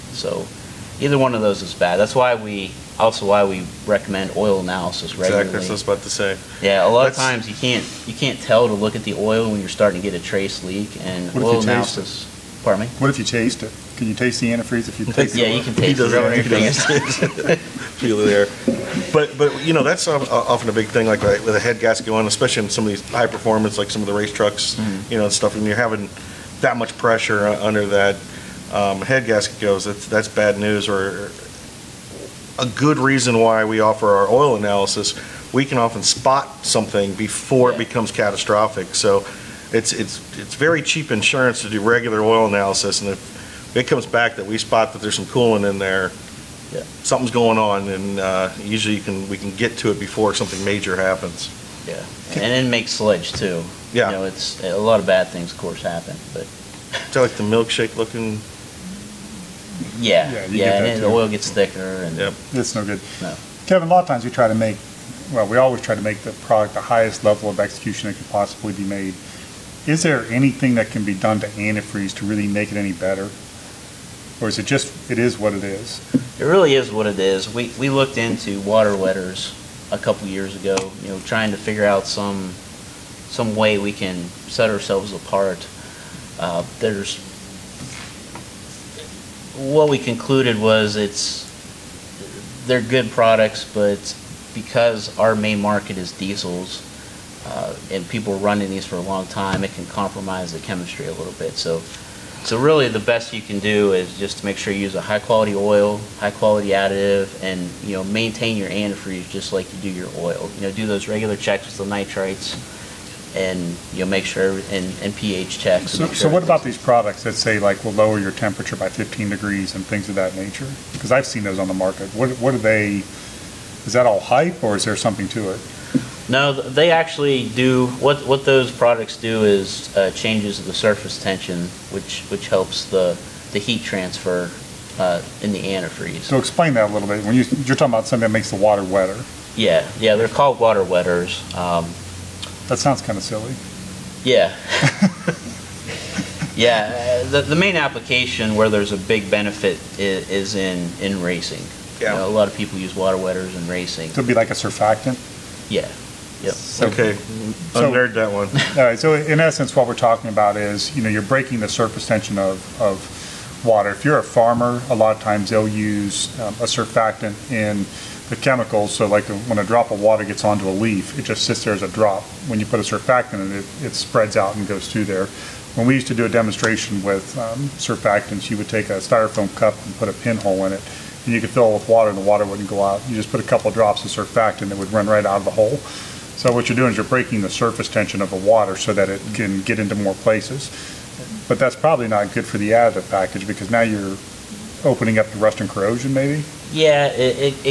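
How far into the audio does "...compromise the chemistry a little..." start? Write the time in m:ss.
1:39.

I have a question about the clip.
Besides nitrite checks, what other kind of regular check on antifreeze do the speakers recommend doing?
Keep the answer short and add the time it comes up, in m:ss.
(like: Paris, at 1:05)
pH checks, at 1:55.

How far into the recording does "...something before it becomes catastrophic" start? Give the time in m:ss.
0:36.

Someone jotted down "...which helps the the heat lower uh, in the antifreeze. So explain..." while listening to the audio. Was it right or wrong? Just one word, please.
wrong.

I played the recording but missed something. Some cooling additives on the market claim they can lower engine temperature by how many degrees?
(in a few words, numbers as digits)
15 degrees.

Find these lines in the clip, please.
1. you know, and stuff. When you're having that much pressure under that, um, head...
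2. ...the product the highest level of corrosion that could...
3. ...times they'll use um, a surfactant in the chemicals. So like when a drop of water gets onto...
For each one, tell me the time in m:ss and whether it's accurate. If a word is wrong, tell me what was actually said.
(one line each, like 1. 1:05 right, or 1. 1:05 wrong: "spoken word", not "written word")
1. 0:25 right
2. 1:06 wrong: "execution", not "corrosion"
3. 2:45 right.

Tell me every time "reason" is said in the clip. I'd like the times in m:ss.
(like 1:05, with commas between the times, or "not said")
0:32.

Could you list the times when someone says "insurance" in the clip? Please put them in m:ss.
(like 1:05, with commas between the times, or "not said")
0:41.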